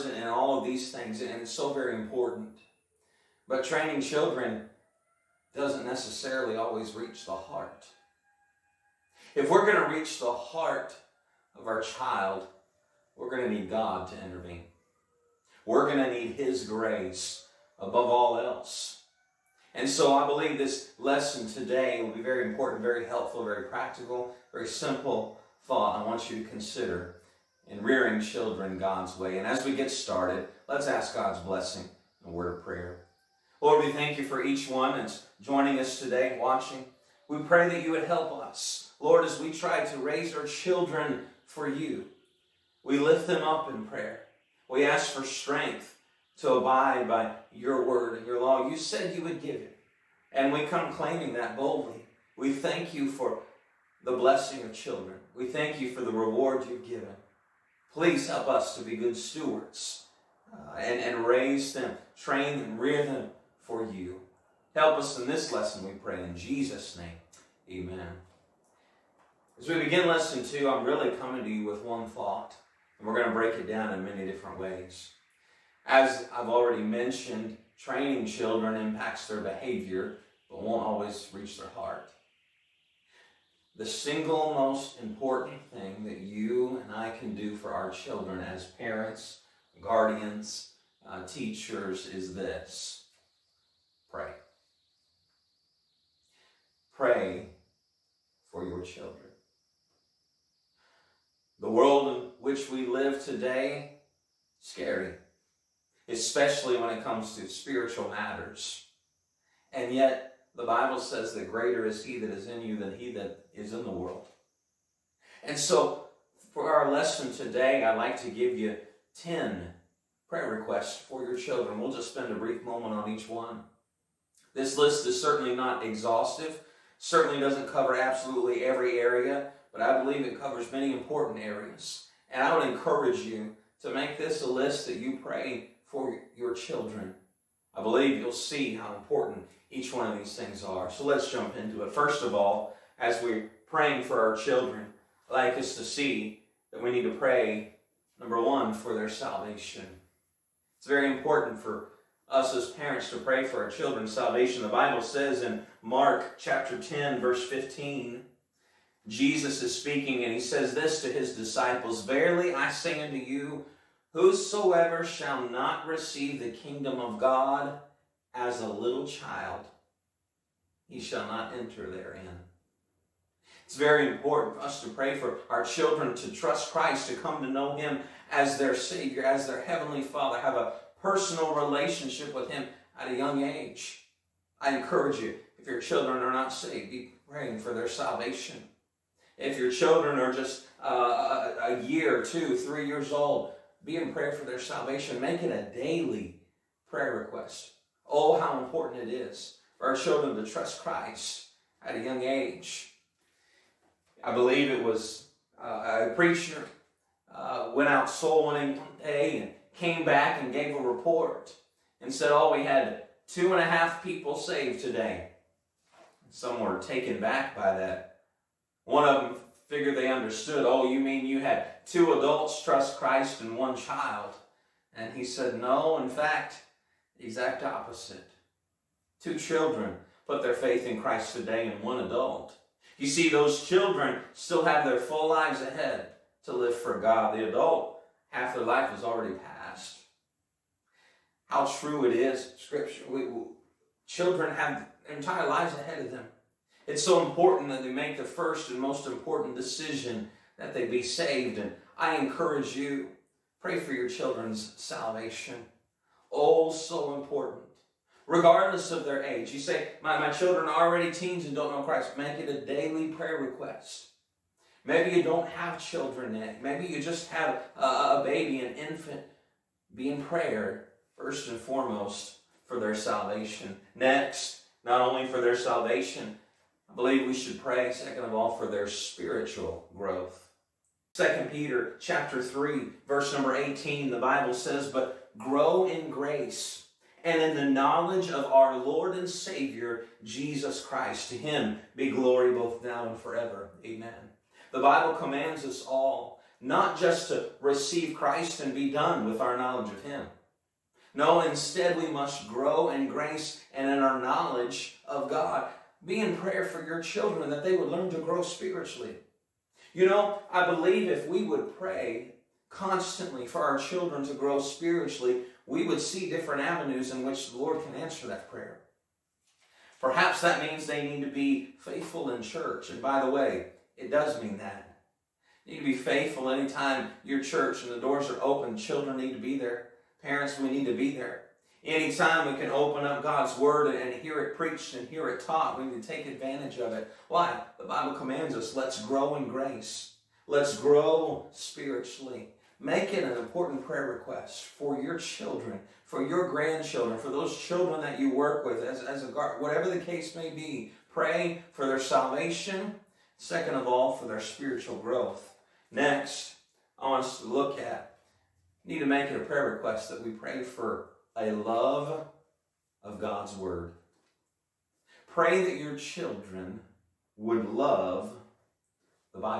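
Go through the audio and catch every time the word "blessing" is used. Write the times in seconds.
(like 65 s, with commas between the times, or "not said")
31 s, 54 s.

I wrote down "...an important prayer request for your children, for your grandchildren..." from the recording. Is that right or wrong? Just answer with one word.
right.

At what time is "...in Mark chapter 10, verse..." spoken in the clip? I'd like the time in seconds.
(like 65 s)
155 s.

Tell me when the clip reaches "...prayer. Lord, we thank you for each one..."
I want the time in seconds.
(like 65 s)
32 s.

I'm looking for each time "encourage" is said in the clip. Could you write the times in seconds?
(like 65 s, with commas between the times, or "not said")
132 s, 184 s, 252 s.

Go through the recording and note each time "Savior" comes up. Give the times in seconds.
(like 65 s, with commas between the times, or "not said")
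178 s, 289 s.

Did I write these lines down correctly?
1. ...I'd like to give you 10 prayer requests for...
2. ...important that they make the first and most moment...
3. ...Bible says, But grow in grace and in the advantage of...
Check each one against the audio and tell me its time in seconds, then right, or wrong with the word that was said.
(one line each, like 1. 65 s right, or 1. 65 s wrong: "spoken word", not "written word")
1. 117 s right
2. 247 s wrong: "important", not "moment"
3. 284 s wrong: "knowledge", not "advantage".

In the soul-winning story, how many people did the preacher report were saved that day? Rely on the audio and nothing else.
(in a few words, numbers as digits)
two and a half.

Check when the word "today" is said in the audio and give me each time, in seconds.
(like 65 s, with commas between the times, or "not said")
21 s, 35 s, 103 s, 117 s, 214 s, 231 s.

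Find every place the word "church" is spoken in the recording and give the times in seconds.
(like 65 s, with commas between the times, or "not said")
322 s, 327 s.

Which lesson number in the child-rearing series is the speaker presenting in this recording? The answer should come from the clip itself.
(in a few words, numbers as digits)
2.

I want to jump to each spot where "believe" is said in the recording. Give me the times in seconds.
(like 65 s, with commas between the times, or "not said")
20 s, 130 s, 137 s, 204 s, 276 s, 310 s.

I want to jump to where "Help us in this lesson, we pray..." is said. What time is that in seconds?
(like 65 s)
64 s.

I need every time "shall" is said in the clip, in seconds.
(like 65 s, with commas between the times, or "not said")
165 s, 170 s.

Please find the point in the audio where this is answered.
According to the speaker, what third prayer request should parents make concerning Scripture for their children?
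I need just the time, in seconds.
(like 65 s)
361 s.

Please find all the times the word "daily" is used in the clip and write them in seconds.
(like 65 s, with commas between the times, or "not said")
195 s, 262 s.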